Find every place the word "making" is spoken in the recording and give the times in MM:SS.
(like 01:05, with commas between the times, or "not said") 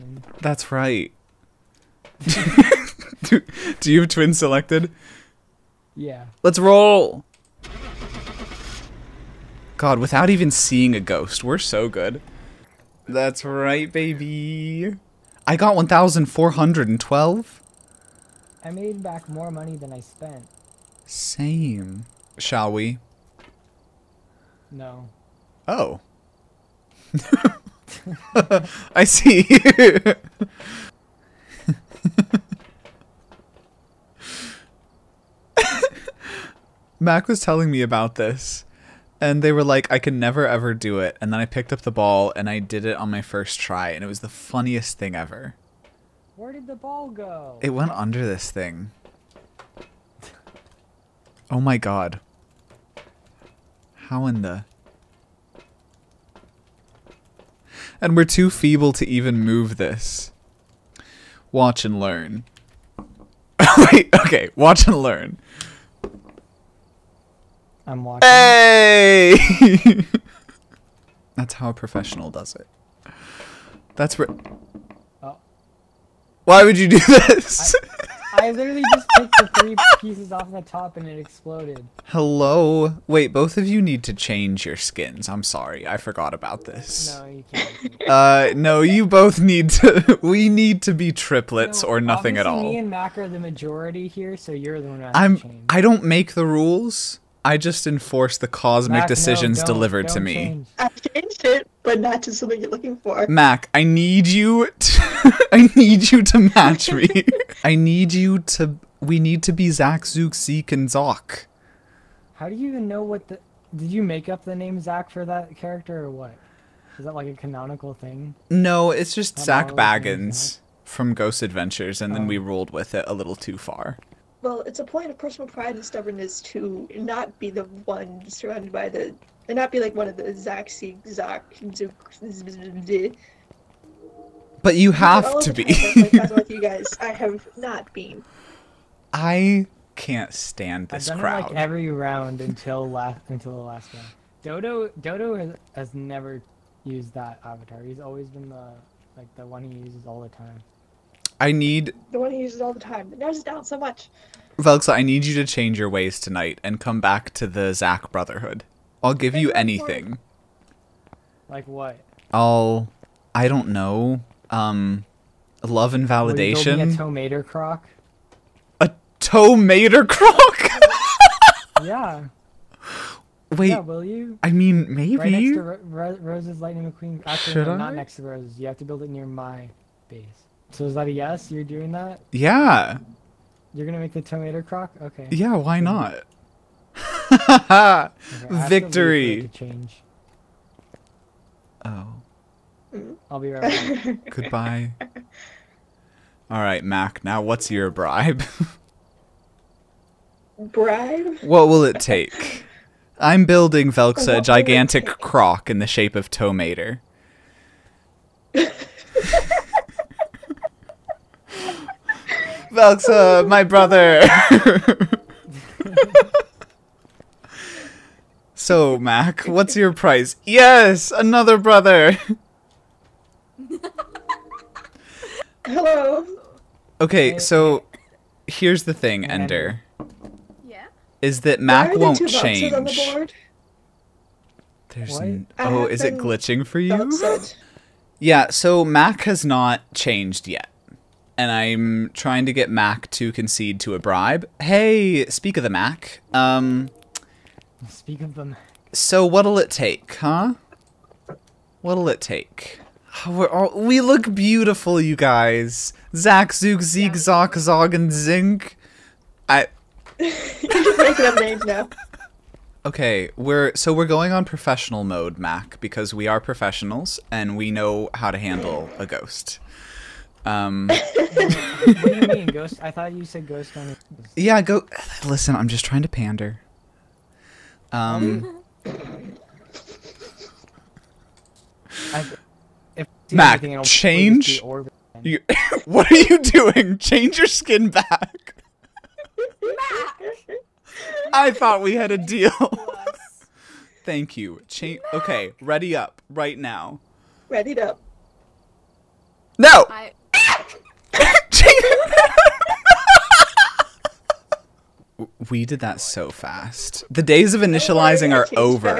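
04:20.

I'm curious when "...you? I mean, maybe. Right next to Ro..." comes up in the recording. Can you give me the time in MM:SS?
02:54.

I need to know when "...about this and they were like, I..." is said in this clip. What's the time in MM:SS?
00:37.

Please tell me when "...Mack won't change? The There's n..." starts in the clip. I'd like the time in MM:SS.
03:51.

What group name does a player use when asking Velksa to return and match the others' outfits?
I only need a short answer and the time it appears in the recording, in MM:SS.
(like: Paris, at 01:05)
Zack Brotherhood, at 02:37.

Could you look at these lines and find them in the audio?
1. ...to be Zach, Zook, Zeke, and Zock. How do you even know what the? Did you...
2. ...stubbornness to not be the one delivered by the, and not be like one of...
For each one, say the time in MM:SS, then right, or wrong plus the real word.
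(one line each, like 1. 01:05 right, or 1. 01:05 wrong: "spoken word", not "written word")
1. 01:49 right
2. 02:05 wrong: "surrounded", not "delivered".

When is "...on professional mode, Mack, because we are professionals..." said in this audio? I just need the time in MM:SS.
04:24.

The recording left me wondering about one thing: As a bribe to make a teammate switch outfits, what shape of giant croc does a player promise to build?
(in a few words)
Tomater.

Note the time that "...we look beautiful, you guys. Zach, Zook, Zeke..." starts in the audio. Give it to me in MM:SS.
04:13.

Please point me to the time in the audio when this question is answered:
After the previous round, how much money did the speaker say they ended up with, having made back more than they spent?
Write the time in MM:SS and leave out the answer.
00:15.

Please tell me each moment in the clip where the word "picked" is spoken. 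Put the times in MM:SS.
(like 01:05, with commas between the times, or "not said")
00:41.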